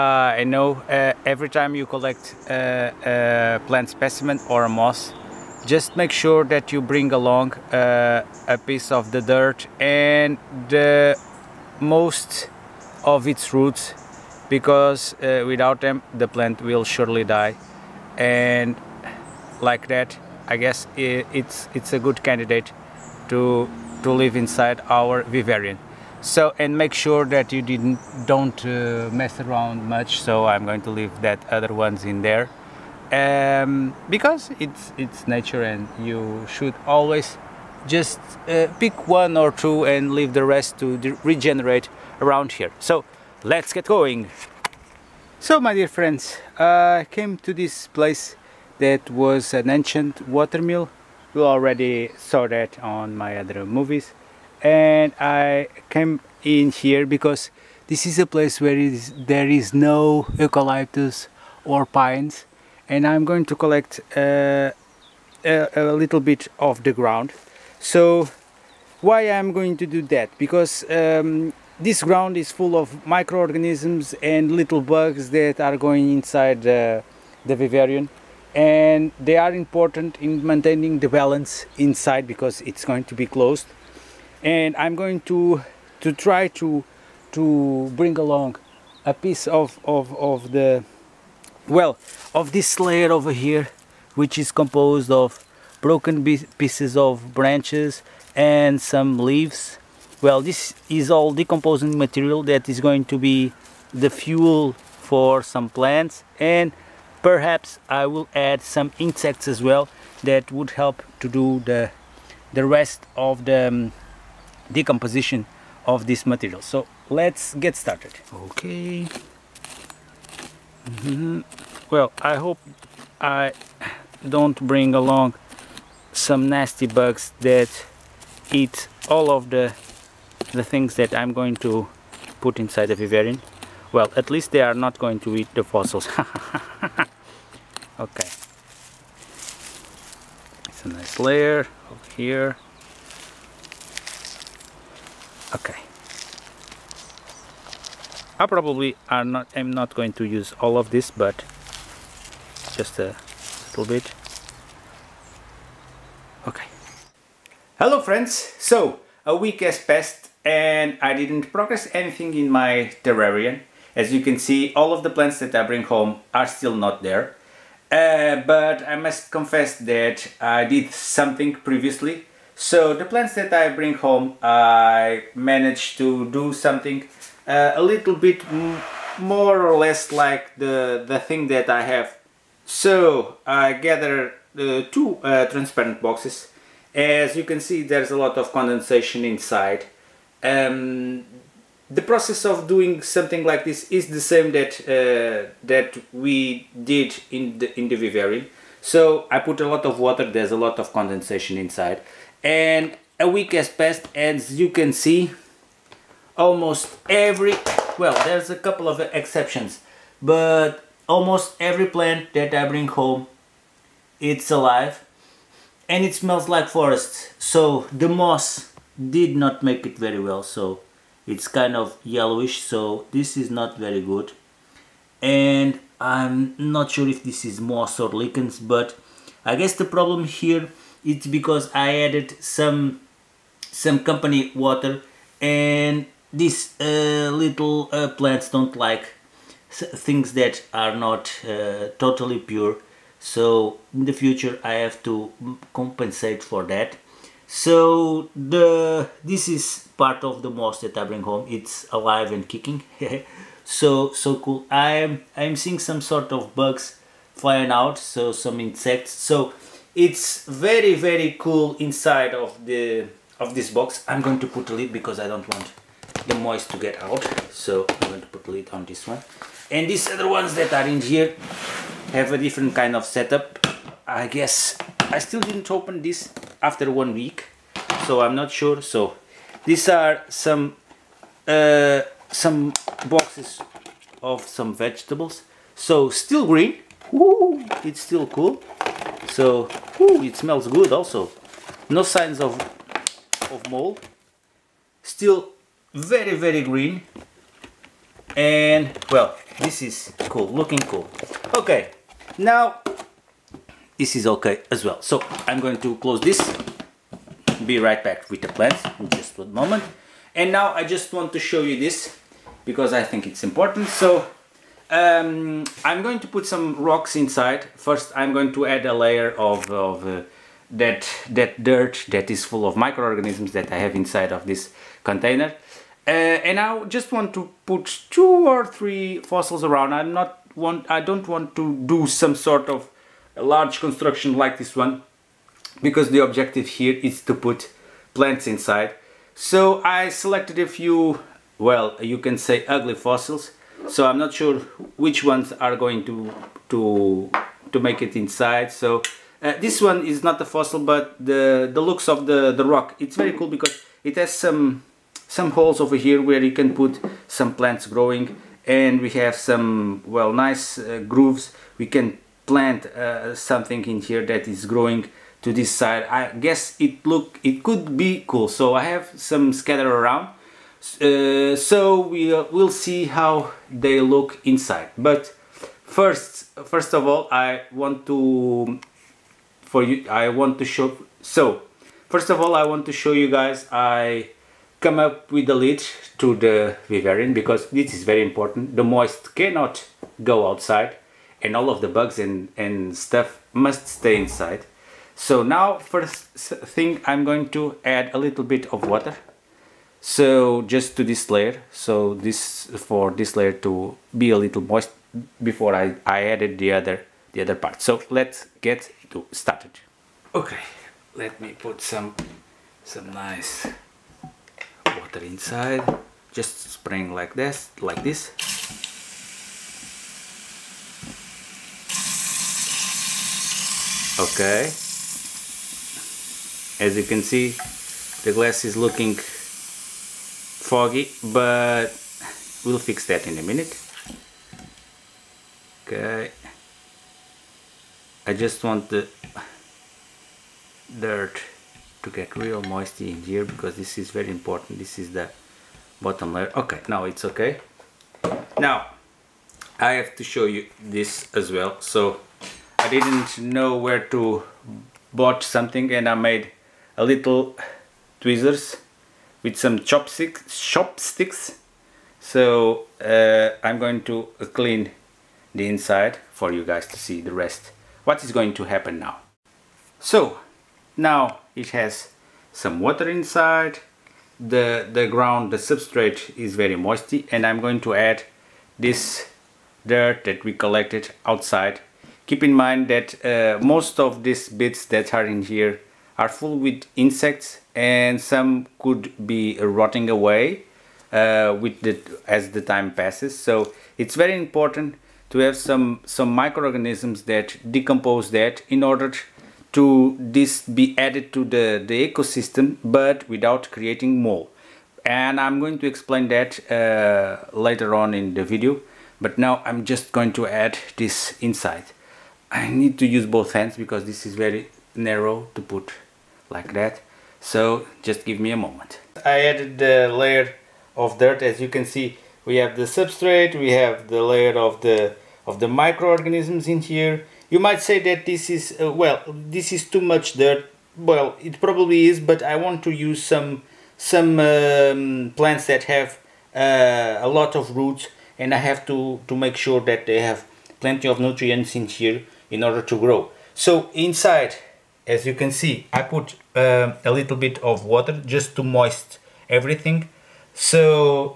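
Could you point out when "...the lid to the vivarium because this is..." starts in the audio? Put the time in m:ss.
6:25.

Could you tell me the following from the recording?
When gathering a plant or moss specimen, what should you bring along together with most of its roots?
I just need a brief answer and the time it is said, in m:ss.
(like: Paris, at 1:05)
a piece of the dirt, at 0:08.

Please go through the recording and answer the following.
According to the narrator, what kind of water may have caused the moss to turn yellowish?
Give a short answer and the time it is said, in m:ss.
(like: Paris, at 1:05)
company water, at 3:54.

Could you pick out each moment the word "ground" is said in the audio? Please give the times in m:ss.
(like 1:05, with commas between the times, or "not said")
1:06, 1:12, 7:55.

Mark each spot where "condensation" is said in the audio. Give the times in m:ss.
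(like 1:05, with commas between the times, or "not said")
3:08, 3:20.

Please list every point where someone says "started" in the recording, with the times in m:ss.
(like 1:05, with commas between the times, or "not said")
1:57, 6:49.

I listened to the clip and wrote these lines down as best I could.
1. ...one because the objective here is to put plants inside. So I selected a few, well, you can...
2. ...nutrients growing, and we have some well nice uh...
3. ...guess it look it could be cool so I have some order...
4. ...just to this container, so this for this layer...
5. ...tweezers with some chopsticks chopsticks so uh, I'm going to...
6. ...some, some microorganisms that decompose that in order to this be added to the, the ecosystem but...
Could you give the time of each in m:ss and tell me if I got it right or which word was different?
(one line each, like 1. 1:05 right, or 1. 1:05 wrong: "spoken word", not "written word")
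1. 5:34 right
2. 5:57 wrong: "plants", not "nutrients"
3. 6:06 wrong: "scatter", not "order"
4. 6:40 wrong: "layer", not "container"
5. 7:38 right
6. 8:15 right.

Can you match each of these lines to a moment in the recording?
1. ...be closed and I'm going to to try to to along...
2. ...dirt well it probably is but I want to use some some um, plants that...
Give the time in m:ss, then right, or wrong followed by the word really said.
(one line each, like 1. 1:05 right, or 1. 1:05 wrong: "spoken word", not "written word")
1. 1:23 wrong: "bring", not "along"
2. 8:50 right.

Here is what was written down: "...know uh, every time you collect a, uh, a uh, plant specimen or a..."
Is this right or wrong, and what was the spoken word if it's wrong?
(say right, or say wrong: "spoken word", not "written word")
right.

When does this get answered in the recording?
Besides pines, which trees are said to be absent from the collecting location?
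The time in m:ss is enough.
1:00.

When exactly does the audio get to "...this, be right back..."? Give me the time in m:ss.
5:06.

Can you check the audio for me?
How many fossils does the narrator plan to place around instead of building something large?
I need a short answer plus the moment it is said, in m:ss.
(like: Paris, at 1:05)
two or three, at 5:28.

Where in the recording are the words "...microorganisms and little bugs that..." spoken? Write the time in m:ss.
1:13.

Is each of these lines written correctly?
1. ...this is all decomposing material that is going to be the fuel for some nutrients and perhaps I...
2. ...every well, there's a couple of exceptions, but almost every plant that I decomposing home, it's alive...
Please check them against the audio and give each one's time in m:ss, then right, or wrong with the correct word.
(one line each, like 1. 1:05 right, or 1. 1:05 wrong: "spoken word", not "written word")
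1. 1:40 wrong: "plants", not "nutrients"
2. 3:27 wrong: "bring", not "decomposing".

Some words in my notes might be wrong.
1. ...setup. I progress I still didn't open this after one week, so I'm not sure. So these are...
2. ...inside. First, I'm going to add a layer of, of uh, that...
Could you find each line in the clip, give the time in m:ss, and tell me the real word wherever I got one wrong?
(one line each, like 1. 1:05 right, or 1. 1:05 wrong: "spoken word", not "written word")
1. 4:33 wrong: "guess", not "progress"
2. 5:17 right.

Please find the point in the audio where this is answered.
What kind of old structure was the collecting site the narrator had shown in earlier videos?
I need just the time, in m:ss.
0:49.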